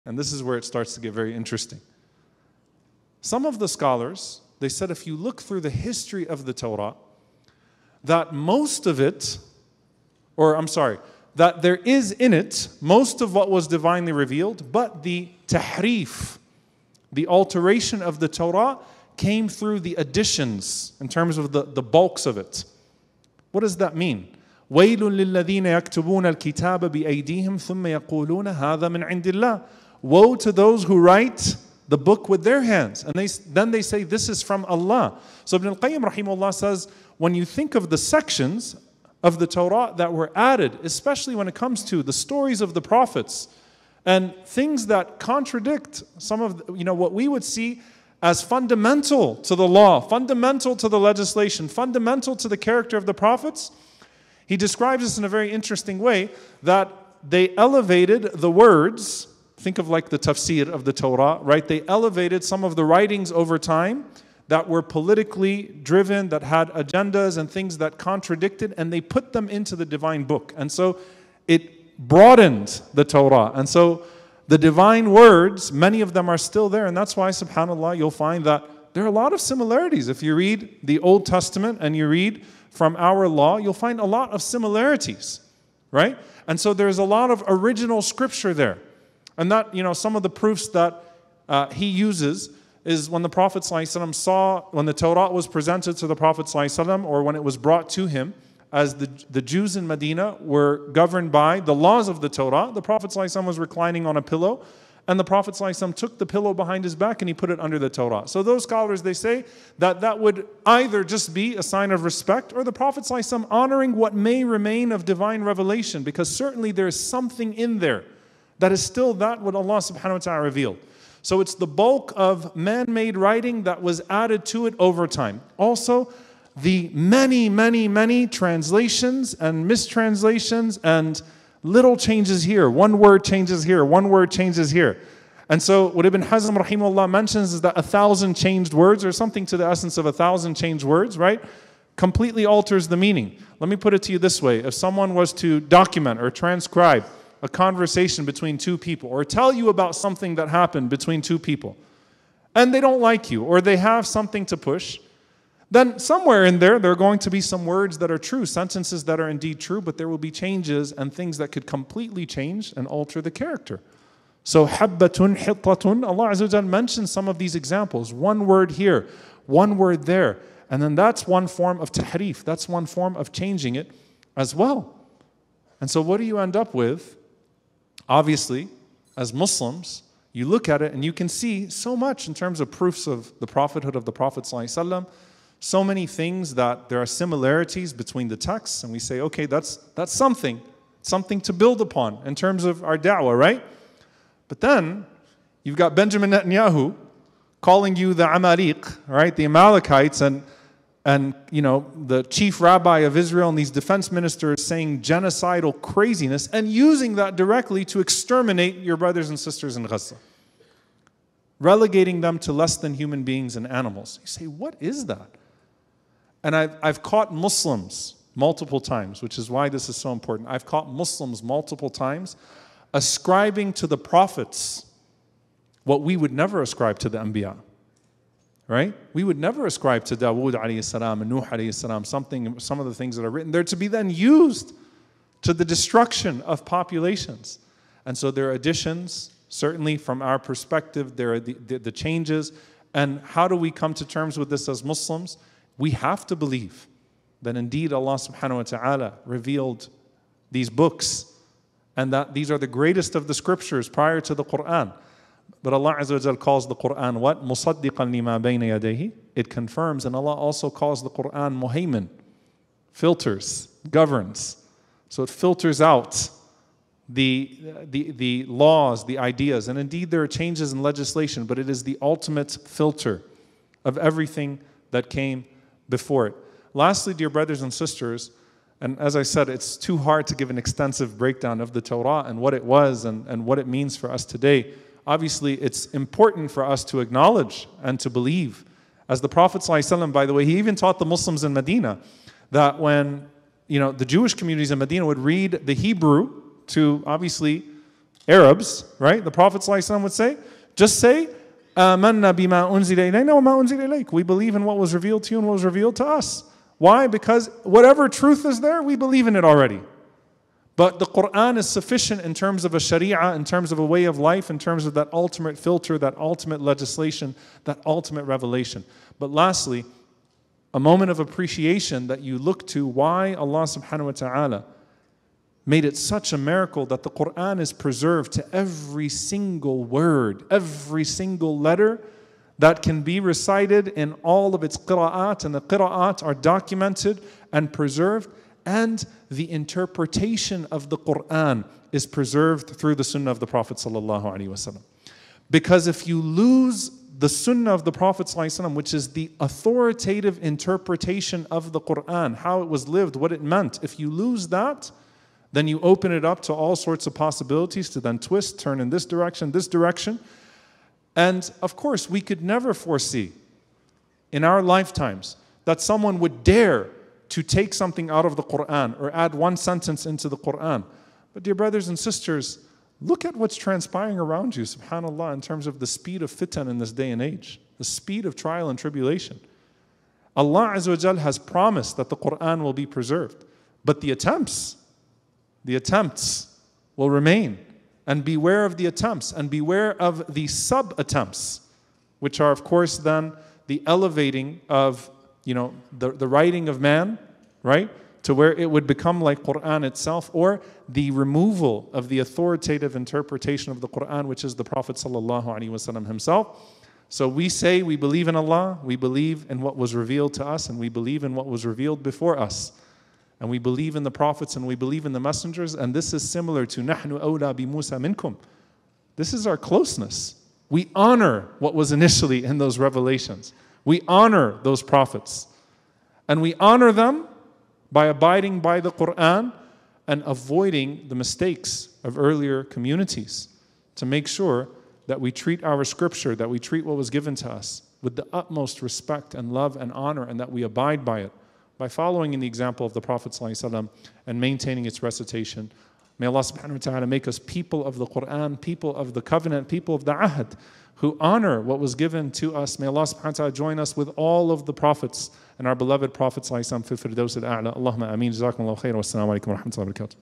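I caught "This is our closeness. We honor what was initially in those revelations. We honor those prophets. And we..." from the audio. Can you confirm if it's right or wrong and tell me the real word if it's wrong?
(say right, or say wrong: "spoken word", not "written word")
right.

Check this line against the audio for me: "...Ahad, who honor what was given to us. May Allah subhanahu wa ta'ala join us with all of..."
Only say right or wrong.
right.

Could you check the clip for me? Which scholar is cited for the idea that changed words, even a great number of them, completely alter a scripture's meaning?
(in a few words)
Ibn Hazm.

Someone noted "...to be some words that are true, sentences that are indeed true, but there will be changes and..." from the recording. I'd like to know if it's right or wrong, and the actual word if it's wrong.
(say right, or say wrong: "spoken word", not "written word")
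right.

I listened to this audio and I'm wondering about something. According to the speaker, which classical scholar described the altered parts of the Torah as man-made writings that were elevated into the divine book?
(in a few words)
Ibn al Qayyim.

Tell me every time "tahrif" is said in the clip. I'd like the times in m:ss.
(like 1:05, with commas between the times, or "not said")
0:15, 2:51.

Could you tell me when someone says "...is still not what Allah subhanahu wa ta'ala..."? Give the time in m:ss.
1:58.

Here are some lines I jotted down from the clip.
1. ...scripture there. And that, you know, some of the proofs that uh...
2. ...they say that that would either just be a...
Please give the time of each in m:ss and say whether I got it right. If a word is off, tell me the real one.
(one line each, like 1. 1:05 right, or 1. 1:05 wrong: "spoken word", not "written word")
1. 1:28 right
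2. 1:49 right.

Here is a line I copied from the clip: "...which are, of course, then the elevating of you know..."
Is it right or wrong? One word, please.
right.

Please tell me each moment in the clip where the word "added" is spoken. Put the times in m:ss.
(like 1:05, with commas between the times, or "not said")
0:40, 2:04.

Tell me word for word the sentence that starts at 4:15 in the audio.
But Allah Azza wa calls the Quran what?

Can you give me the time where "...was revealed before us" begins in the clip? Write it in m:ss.
6:51.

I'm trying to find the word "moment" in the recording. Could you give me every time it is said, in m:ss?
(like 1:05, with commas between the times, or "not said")
5:20.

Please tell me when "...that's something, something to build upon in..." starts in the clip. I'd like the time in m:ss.
3:09.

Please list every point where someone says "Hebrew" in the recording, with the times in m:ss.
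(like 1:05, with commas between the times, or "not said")
4:55.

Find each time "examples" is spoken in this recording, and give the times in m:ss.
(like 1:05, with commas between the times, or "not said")
2:47, 7:22.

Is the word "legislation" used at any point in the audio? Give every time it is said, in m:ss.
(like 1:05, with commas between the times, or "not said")
0:50, 4:30, 5:16.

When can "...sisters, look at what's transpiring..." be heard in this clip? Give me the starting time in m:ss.
6:11.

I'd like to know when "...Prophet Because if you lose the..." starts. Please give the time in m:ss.
5:43.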